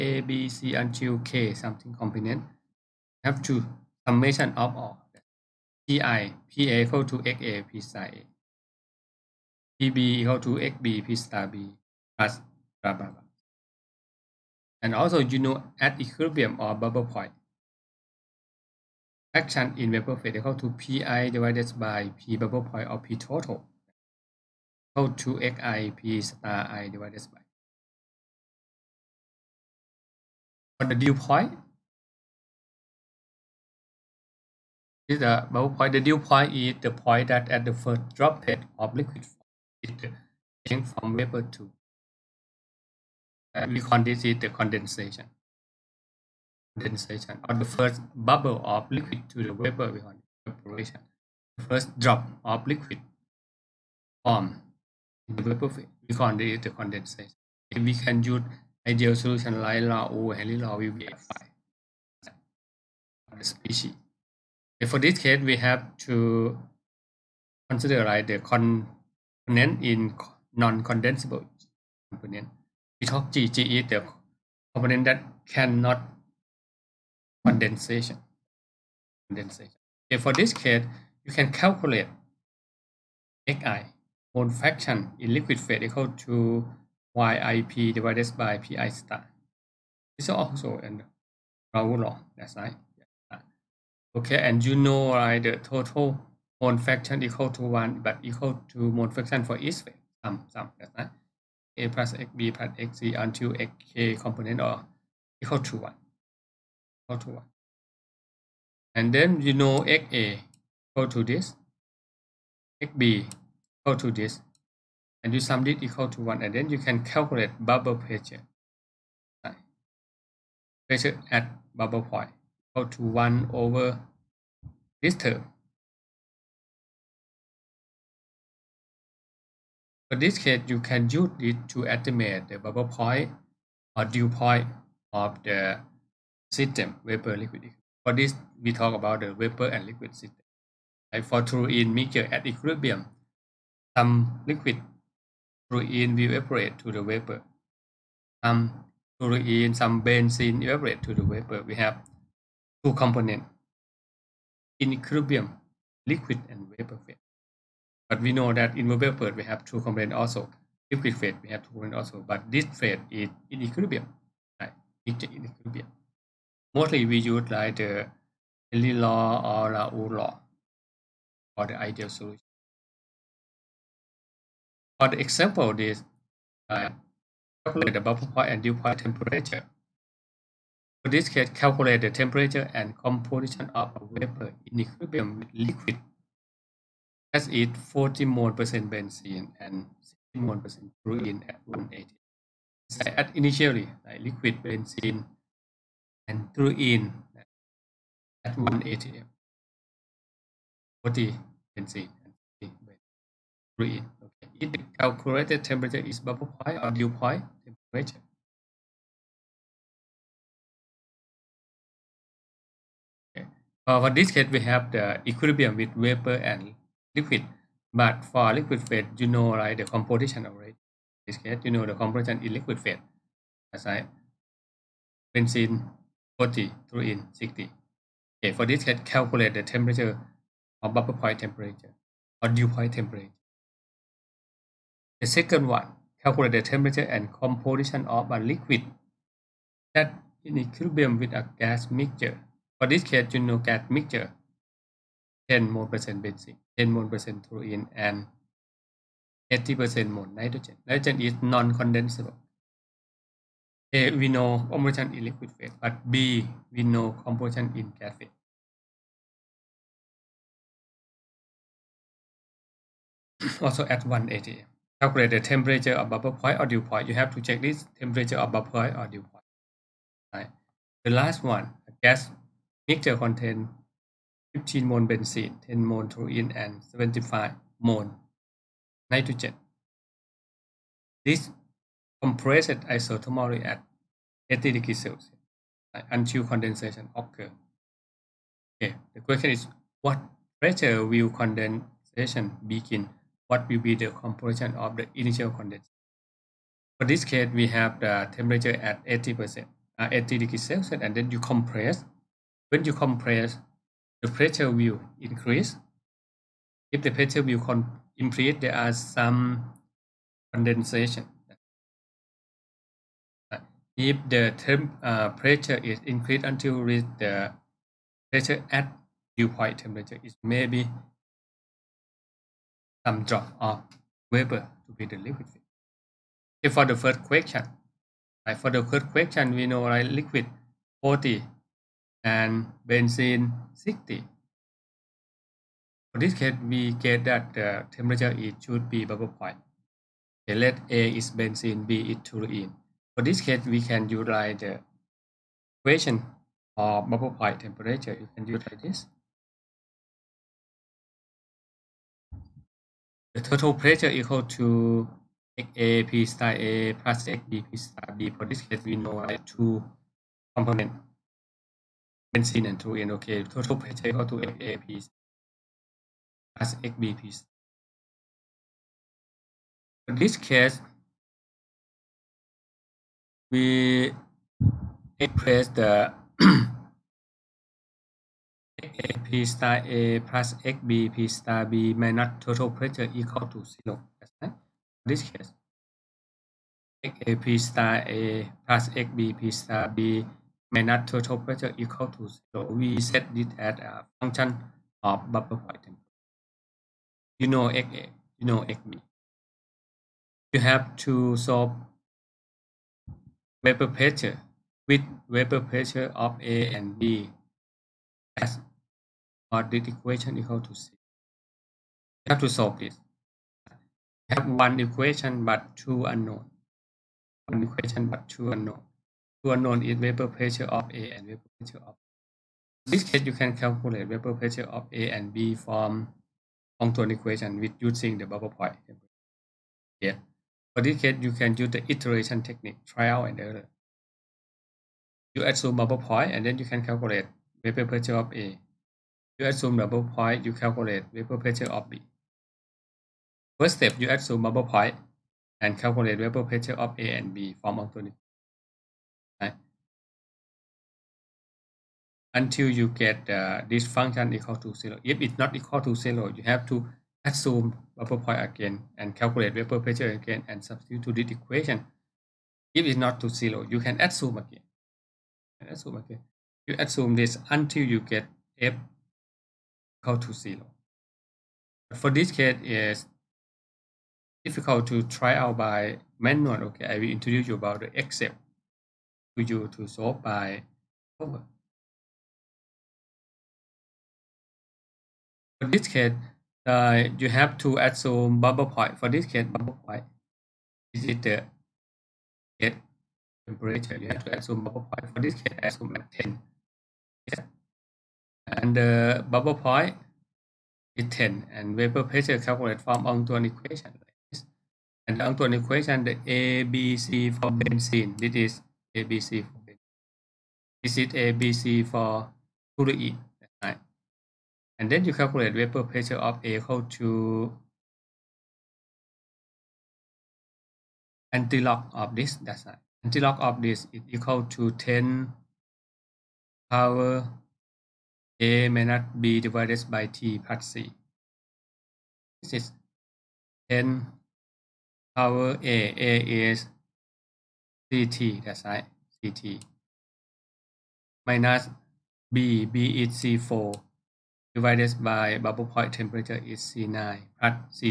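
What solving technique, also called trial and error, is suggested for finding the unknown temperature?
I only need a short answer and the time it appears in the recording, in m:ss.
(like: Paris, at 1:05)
Iteration technique, at 7:11.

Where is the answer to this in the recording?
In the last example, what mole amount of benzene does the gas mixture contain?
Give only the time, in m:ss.
4:34.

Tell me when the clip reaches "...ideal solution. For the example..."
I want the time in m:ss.
2:51.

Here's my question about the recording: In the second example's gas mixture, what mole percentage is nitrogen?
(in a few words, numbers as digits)
80%.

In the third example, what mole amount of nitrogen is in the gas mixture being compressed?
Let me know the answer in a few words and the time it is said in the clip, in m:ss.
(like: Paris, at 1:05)
75, at 4:36.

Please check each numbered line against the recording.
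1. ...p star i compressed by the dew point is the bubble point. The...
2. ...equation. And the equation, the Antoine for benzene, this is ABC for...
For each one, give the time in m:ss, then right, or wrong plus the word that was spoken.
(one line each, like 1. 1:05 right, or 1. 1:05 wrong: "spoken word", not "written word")
1. 0:25 wrong: "divided", not "compressed"
2. 8:23 wrong: "ABC", not "Antoine".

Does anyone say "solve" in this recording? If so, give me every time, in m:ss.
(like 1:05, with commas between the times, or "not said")
6:41, 6:52, 7:59.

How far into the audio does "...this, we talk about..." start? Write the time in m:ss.
2:18.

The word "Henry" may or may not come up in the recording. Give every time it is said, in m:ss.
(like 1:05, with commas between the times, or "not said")
2:48.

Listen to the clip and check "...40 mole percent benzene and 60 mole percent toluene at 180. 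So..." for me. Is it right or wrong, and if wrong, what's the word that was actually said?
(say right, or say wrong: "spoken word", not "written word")
right.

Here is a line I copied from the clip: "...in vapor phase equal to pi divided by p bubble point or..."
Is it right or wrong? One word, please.
right.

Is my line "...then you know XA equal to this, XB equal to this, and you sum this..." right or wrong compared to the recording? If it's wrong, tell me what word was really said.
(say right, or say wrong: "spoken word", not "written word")
right.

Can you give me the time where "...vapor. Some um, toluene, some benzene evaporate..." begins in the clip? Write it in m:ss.
2:27.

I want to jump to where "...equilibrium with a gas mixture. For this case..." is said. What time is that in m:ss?
4:00.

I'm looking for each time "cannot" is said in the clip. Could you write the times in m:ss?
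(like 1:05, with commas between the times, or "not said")
1:15.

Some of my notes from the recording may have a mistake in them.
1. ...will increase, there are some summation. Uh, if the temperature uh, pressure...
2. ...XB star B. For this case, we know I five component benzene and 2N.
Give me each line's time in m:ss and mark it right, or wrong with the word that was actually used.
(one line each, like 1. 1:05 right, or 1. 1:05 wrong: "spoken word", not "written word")
1. 5:07 wrong: "condensation", not "summation"
2. 5:57 wrong: "two", not "five".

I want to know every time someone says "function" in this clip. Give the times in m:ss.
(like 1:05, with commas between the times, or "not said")
6:34, 7:33.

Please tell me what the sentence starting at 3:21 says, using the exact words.
40 benzene and 60 toluene if the calculated temperature is bubble point or dew point temperature.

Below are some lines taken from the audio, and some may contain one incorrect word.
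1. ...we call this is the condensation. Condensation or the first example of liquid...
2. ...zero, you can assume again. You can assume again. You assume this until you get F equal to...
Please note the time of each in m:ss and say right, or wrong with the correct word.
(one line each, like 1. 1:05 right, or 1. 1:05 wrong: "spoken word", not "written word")
1. 0:43 wrong: "bubble", not "example"
2. 7:43 right.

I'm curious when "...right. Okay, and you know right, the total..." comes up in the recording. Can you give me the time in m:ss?
1:32.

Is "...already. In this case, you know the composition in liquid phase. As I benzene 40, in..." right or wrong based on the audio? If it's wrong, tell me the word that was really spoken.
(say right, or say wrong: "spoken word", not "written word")
right.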